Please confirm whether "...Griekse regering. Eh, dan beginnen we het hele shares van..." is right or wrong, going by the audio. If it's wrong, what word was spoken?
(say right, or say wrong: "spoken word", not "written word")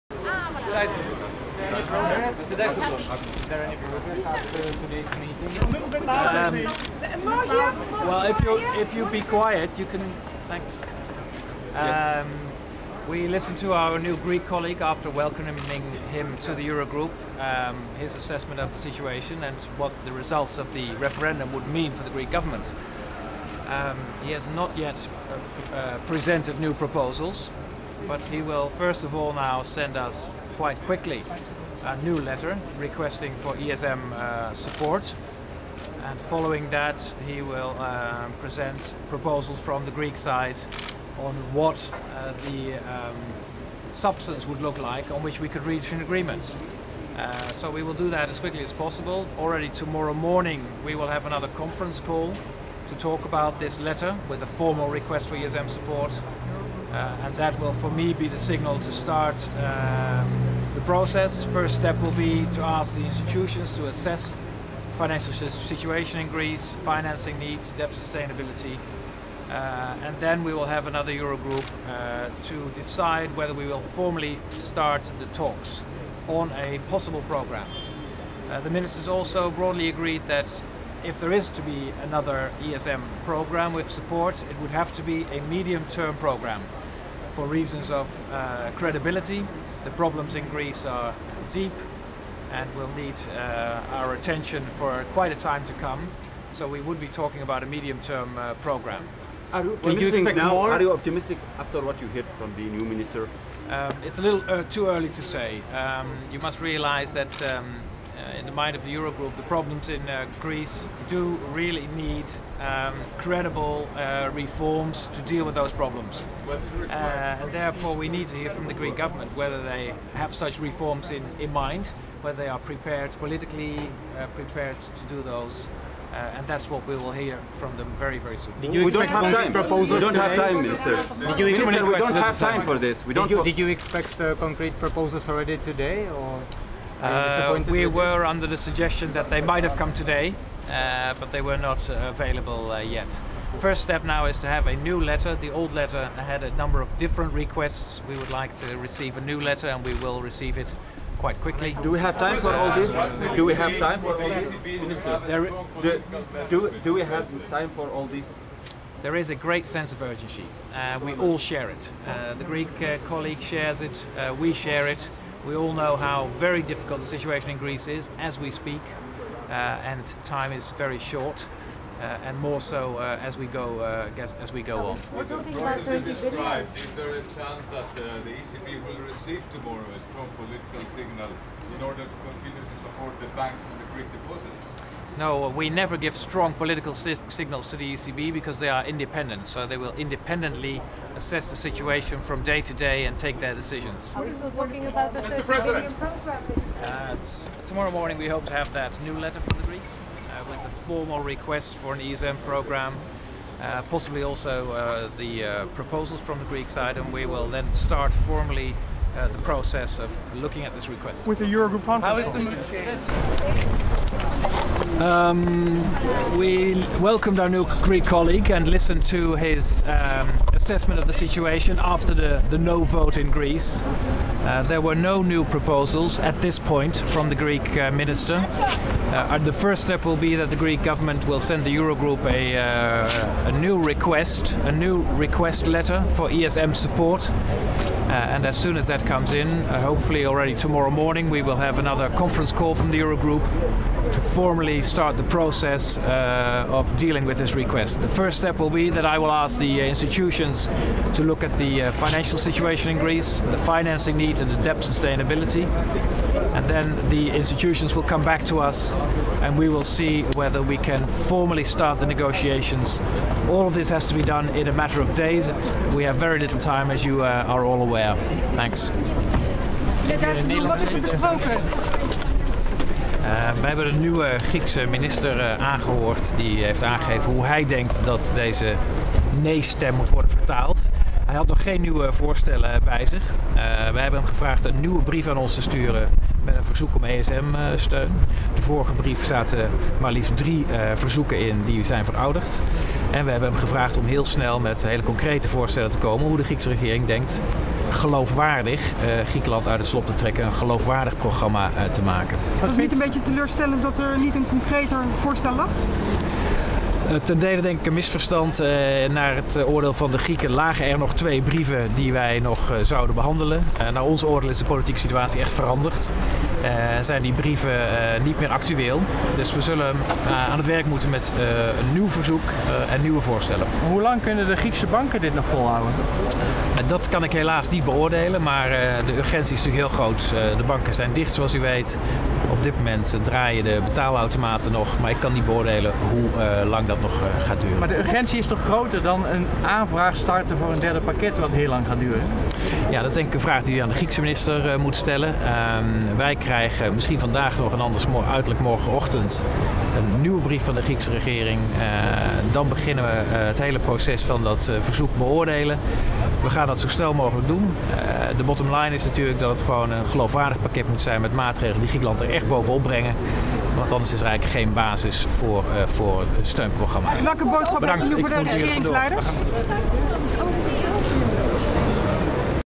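wrong: "proces", not "shares".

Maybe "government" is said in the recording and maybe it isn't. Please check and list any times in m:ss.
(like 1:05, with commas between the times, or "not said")
0:22, 1:58, 3:50.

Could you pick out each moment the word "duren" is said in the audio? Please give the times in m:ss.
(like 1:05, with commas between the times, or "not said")
5:37, 5:41.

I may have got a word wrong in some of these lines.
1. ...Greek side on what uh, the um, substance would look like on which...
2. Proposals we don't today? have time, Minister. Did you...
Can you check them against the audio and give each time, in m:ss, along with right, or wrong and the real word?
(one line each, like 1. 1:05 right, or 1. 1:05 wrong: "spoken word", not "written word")
1. 0:39 right
2. 2:09 right.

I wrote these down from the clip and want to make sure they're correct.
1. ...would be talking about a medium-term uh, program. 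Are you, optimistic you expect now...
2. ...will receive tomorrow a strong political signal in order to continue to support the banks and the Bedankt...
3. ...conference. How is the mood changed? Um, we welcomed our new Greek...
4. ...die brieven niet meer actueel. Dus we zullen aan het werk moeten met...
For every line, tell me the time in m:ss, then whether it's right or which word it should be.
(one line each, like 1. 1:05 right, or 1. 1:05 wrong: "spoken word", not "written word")
1. 1:36 right
2. 2:58 wrong: "Greek", not "Bedankt"
3. 3:31 right
4. 5:17 right.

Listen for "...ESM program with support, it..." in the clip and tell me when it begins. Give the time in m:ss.
1:22.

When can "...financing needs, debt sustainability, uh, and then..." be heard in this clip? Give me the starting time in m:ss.
1:06.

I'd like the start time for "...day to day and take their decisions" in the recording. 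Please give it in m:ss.
3:12.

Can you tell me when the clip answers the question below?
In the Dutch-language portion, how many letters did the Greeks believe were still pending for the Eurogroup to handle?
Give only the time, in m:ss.
5:11.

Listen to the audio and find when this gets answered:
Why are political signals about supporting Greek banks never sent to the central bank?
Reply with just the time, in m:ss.
3:08.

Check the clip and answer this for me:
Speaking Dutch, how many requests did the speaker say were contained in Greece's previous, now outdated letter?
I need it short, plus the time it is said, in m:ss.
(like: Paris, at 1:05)
3, at 4:50.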